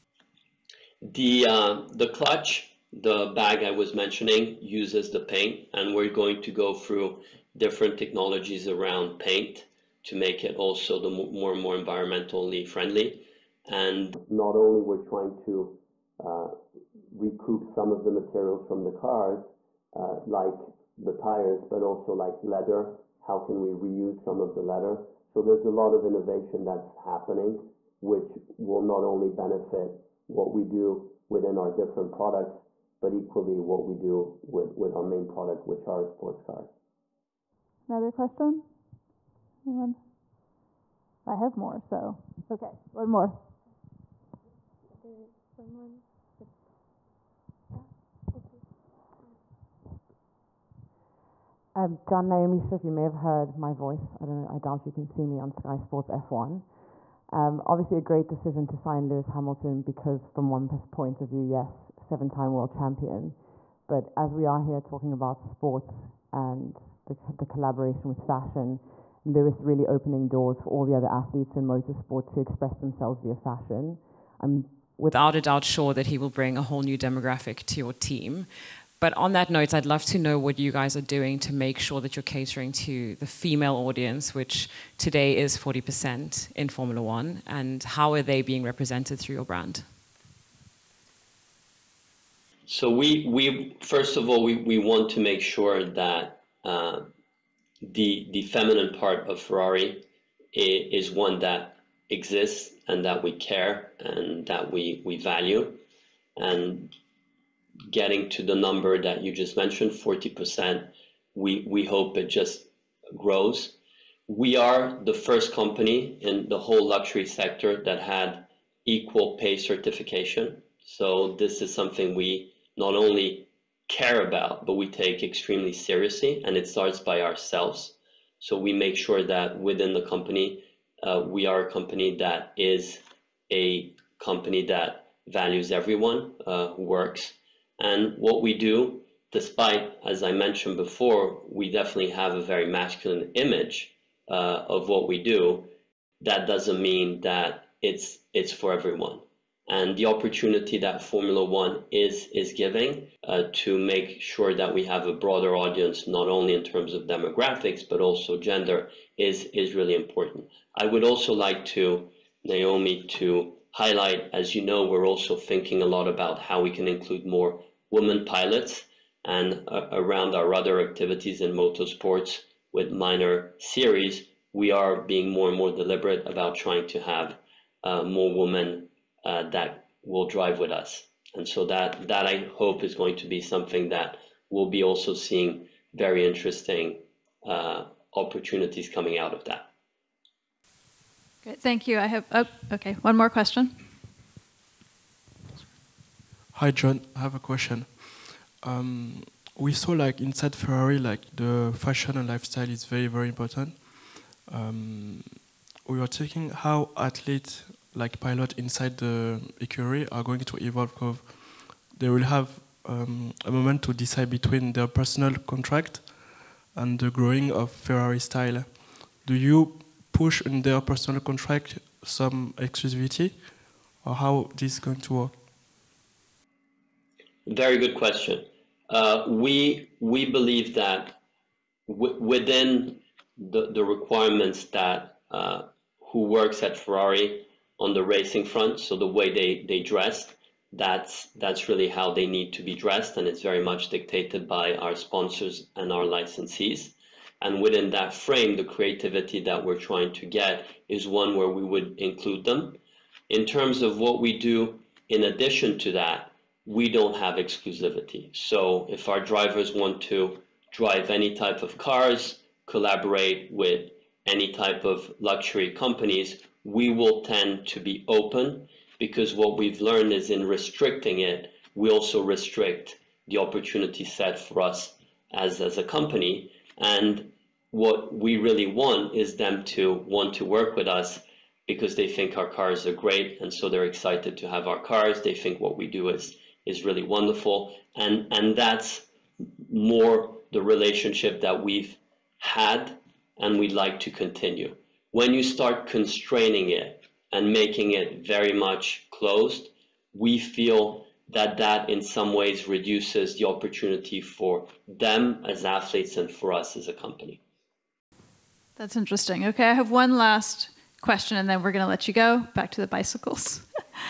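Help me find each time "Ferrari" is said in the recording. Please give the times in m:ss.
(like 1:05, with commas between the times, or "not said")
1:39, 3:20, 3:37, 3:56.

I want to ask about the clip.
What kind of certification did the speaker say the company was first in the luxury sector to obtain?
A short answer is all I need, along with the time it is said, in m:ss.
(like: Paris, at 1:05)
equal pay certification, at 1:58.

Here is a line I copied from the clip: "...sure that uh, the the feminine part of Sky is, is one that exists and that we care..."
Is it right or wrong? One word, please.
wrong.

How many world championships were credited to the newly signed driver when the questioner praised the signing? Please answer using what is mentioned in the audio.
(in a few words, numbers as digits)
7.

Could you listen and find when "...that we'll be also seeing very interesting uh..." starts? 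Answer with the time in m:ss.
3:03.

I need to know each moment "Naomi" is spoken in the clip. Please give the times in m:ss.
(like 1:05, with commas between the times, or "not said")
0:52, 2:42.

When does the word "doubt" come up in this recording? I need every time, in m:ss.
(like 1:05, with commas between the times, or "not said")
0:54, 1:15.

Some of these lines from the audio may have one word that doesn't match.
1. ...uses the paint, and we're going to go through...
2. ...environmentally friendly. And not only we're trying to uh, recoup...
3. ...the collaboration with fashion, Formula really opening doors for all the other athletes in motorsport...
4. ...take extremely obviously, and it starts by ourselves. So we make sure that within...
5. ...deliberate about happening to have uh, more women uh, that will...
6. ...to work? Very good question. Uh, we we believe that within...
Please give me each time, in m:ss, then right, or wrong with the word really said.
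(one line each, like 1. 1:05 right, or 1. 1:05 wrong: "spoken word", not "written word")
1. 0:04 right
2. 0:11 right
3. 1:07 wrong: "Lewis", not "Formula"
4. 2:04 wrong: "seriously", not "obviously"
5. 2:55 wrong: "trying", not "happening"
6. 3:45 right.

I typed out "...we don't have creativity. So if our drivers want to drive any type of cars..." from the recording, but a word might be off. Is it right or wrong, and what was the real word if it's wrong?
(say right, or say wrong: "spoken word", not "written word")
wrong: "exclusivity", not "creativity".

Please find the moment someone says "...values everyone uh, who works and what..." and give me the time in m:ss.
2:15.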